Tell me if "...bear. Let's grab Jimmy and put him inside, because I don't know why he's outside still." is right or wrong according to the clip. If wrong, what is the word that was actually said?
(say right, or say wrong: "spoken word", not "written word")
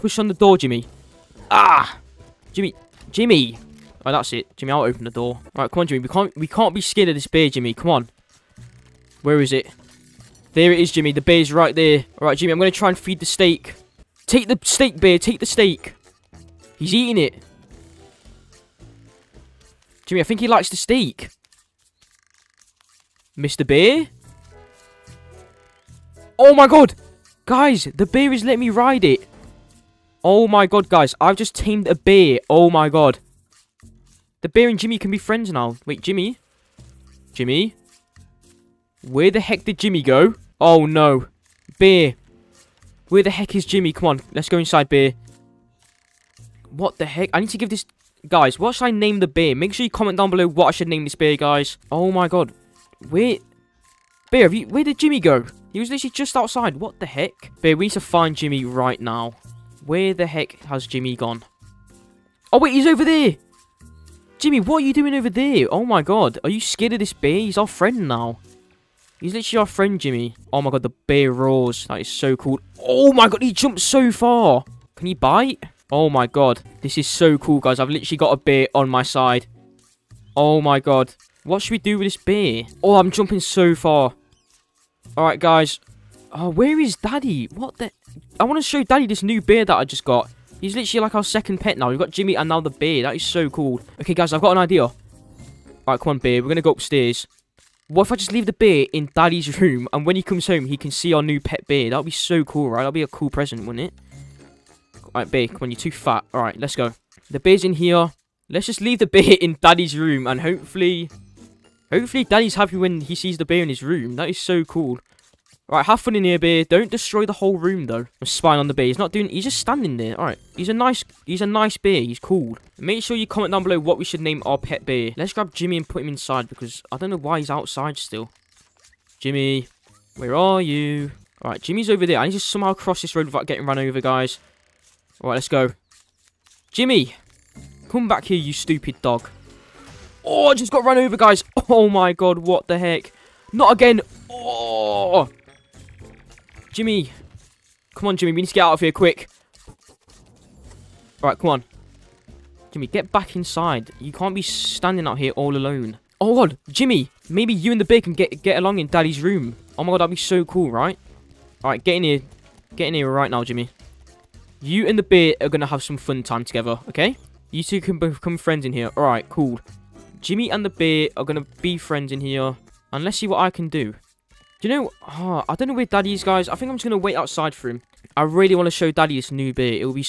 right.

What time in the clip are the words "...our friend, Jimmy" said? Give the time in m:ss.
1:09.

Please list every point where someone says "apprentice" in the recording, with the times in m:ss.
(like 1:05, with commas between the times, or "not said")
not said.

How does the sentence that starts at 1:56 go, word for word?
Don't destroy the whole room, though.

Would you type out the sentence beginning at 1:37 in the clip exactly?
What if I just leave the beer in Daddy's room, and when he comes home, he can see our new pet beer?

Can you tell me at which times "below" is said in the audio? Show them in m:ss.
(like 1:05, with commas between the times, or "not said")
0:50, 2:03.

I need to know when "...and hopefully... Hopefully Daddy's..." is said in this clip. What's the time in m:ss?
1:50.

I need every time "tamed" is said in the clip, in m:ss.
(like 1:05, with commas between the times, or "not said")
0:31.